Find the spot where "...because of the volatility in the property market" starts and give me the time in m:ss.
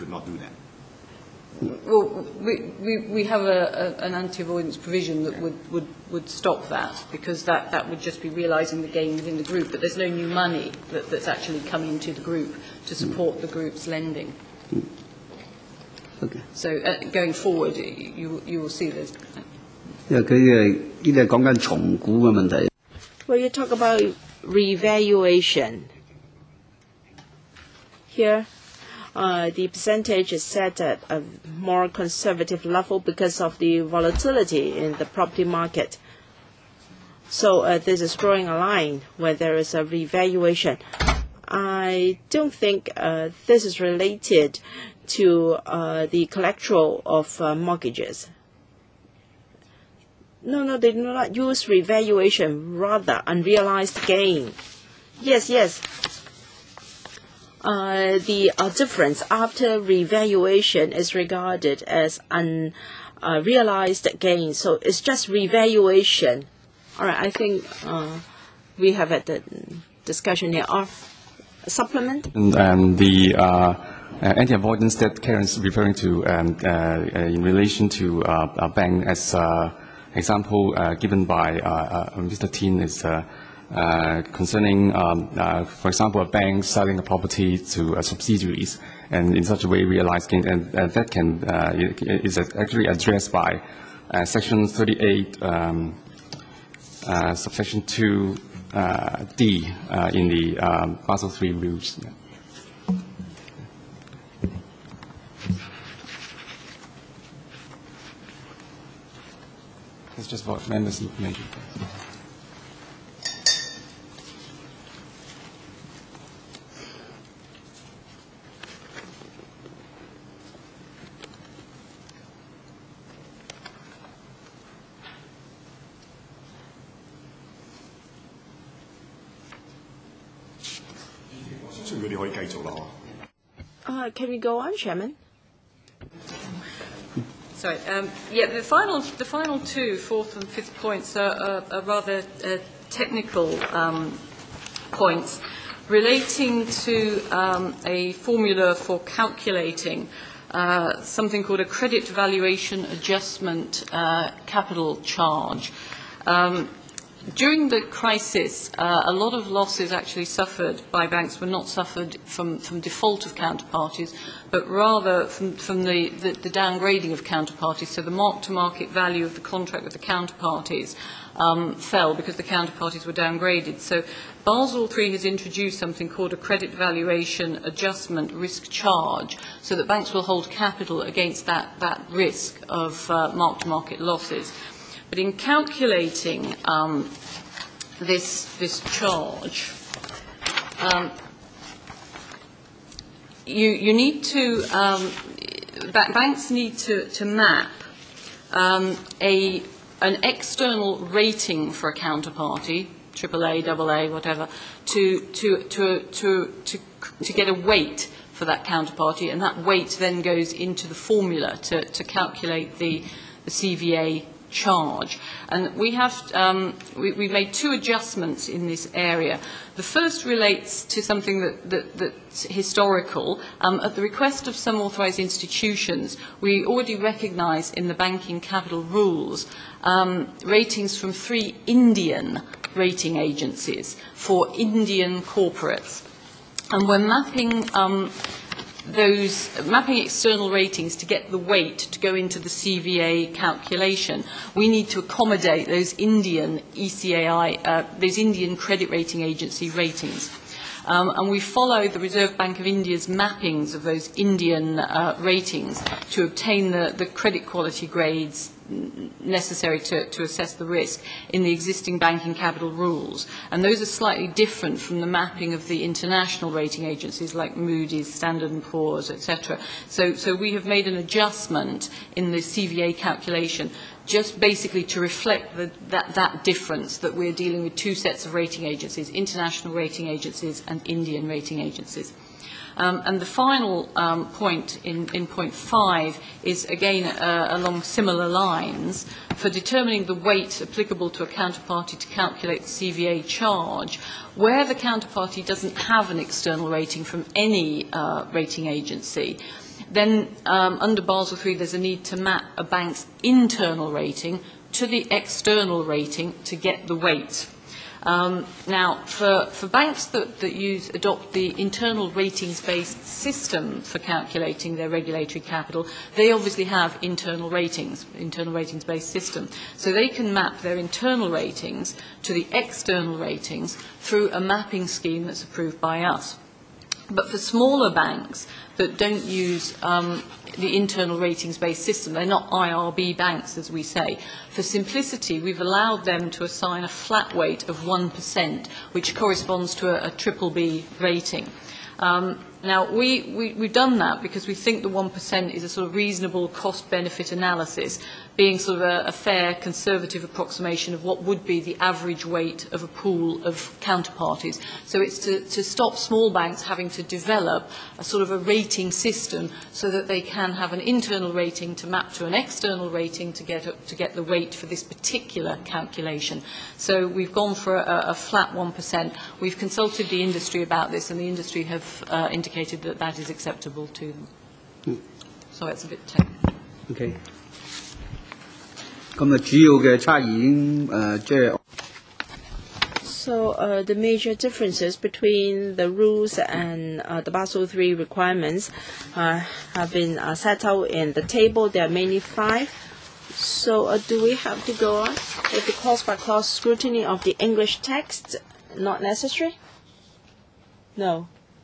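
0:32.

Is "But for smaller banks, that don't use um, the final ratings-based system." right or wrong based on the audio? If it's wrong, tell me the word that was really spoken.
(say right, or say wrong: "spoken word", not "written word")
wrong: "internal", not "final".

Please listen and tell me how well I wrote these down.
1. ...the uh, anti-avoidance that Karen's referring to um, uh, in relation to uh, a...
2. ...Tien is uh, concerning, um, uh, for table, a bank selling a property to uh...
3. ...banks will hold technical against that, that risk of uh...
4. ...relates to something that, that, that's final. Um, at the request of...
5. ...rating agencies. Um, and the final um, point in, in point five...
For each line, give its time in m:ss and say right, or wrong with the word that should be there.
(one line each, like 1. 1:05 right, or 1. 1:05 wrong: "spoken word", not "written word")
1. 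1:12 right
2. 1:22 wrong: "example", not "table"
3. 2:59 wrong: "capital", not "technical"
4. 3:40 wrong: "historical", not "final"
5. 4:41 right.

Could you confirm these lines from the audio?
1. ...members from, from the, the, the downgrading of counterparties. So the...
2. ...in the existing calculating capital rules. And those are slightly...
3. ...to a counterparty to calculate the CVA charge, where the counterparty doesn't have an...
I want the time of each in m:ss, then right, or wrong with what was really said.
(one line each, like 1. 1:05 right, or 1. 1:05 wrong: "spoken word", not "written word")
1. 2:44 wrong: "rather", not "members"
2. 4:21 wrong: "banking", not "calculating"
3. 4:51 right.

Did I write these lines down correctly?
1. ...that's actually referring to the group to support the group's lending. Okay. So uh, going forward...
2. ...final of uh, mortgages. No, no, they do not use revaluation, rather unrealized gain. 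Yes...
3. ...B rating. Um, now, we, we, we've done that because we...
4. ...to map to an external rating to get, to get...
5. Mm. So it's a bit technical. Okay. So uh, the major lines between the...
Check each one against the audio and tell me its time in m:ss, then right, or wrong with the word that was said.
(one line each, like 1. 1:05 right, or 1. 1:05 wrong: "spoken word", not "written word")
1. 0:11 wrong: "coming", not "referring"
2. 0:46 wrong: "collateral", not "final"
3. 5:40 right
4. 6:01 right
5. 6:14 wrong: "differences", not "lines".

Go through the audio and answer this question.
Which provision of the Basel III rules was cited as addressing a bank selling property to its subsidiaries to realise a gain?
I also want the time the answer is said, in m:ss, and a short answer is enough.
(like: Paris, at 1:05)
Section 38(2)(d), at 1:34.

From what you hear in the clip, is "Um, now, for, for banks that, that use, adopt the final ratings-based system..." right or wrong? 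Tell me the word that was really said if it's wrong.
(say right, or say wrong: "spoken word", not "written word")
wrong: "internal", not "final".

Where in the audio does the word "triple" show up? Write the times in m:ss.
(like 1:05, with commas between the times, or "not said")
5:40.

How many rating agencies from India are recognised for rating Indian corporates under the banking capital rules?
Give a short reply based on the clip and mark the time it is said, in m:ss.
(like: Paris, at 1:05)
3, at 3:51.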